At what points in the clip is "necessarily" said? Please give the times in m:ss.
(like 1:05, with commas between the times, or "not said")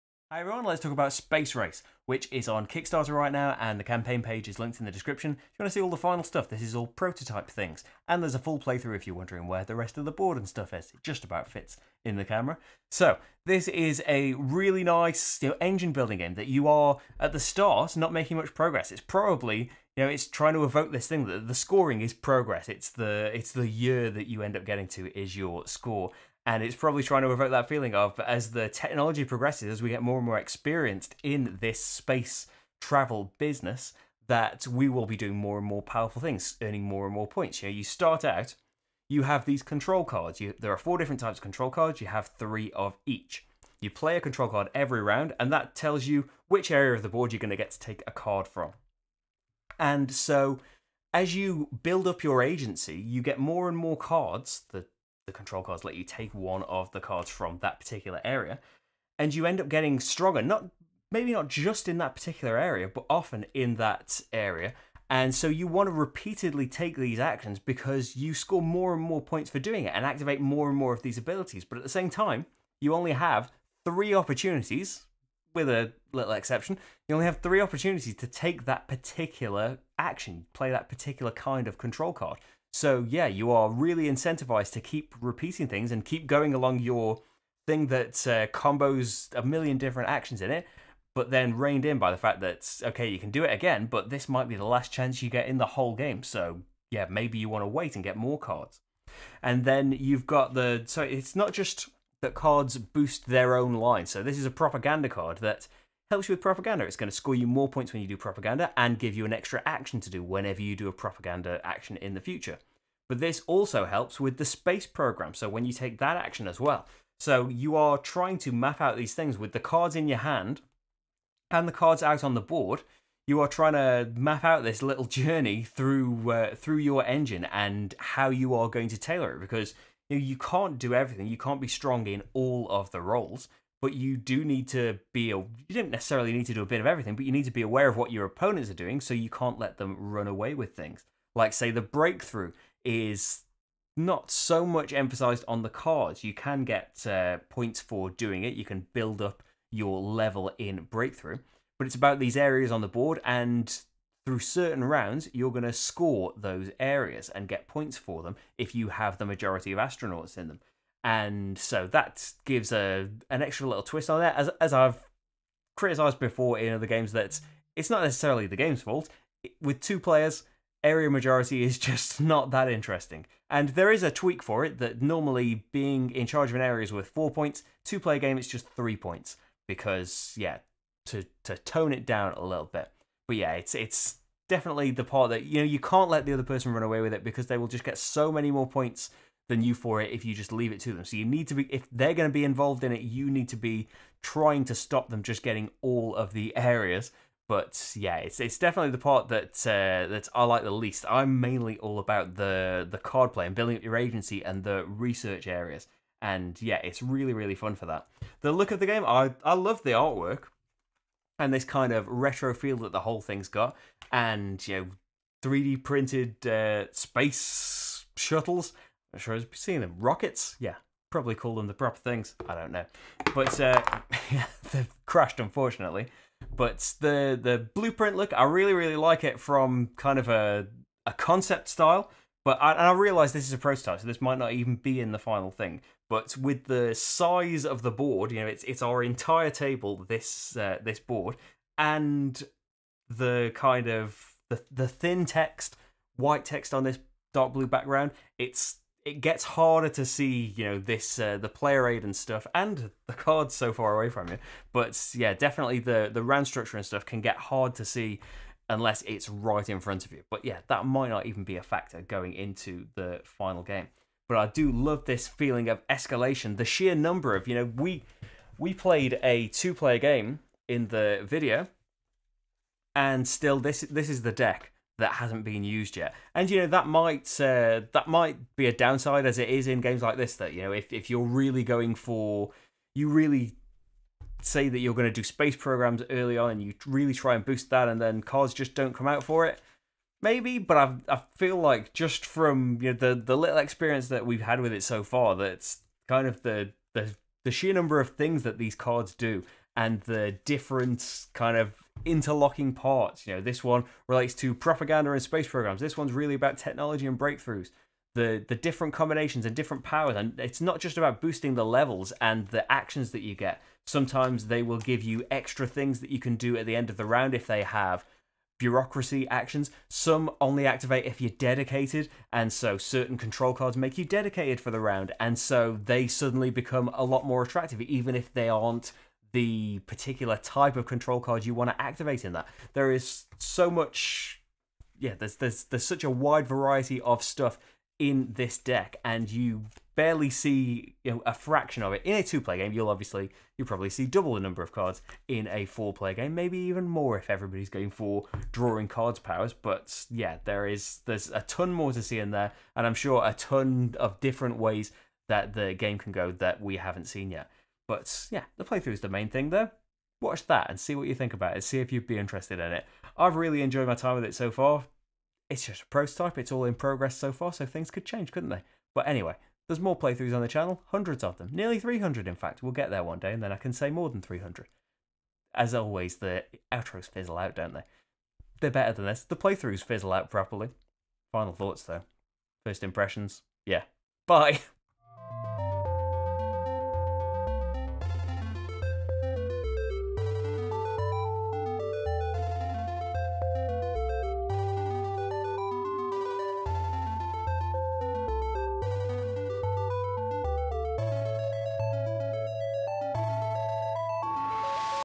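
2:15, 2:48.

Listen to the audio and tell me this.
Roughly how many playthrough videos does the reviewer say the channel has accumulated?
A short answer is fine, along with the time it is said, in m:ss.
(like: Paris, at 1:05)
nearly 300, at 6:11.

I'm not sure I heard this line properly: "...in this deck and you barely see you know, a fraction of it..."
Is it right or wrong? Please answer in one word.
right.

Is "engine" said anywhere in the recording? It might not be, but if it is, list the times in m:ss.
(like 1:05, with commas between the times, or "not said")
0:15, 2:07.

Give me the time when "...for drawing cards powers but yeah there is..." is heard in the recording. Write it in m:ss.
5:47.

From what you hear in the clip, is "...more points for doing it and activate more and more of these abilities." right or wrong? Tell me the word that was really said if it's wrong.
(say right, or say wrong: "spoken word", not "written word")
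right.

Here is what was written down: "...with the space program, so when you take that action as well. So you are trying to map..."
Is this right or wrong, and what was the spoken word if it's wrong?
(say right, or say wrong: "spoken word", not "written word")
right.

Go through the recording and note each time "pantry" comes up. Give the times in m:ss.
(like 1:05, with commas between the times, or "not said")
not said.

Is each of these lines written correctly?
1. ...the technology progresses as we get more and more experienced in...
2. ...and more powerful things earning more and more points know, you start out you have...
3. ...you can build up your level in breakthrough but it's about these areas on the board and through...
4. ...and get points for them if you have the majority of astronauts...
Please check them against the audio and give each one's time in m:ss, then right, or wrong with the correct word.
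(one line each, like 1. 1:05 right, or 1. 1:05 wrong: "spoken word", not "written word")
1. 0:28 right
2. 0:35 right
3. 2:28 right
4. 2:37 right.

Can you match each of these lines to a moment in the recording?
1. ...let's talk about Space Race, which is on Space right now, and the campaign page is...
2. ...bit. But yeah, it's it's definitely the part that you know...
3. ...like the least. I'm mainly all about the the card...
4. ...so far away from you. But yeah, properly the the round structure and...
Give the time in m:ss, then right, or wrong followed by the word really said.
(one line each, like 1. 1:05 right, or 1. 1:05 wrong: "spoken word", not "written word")
1. 0:00 wrong: "Kickstarter", not "Space"
2. 3:02 right
3. 3:20 right
4. 4:13 wrong: "definitely", not "properly".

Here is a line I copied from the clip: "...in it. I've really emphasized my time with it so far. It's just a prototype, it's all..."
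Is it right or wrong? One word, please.
wrong.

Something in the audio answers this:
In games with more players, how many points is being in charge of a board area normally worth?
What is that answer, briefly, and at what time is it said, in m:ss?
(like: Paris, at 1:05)
4, at 2:57.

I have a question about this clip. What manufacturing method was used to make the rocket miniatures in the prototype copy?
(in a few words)
3D printed.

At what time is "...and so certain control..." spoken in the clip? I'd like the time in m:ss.
5:22.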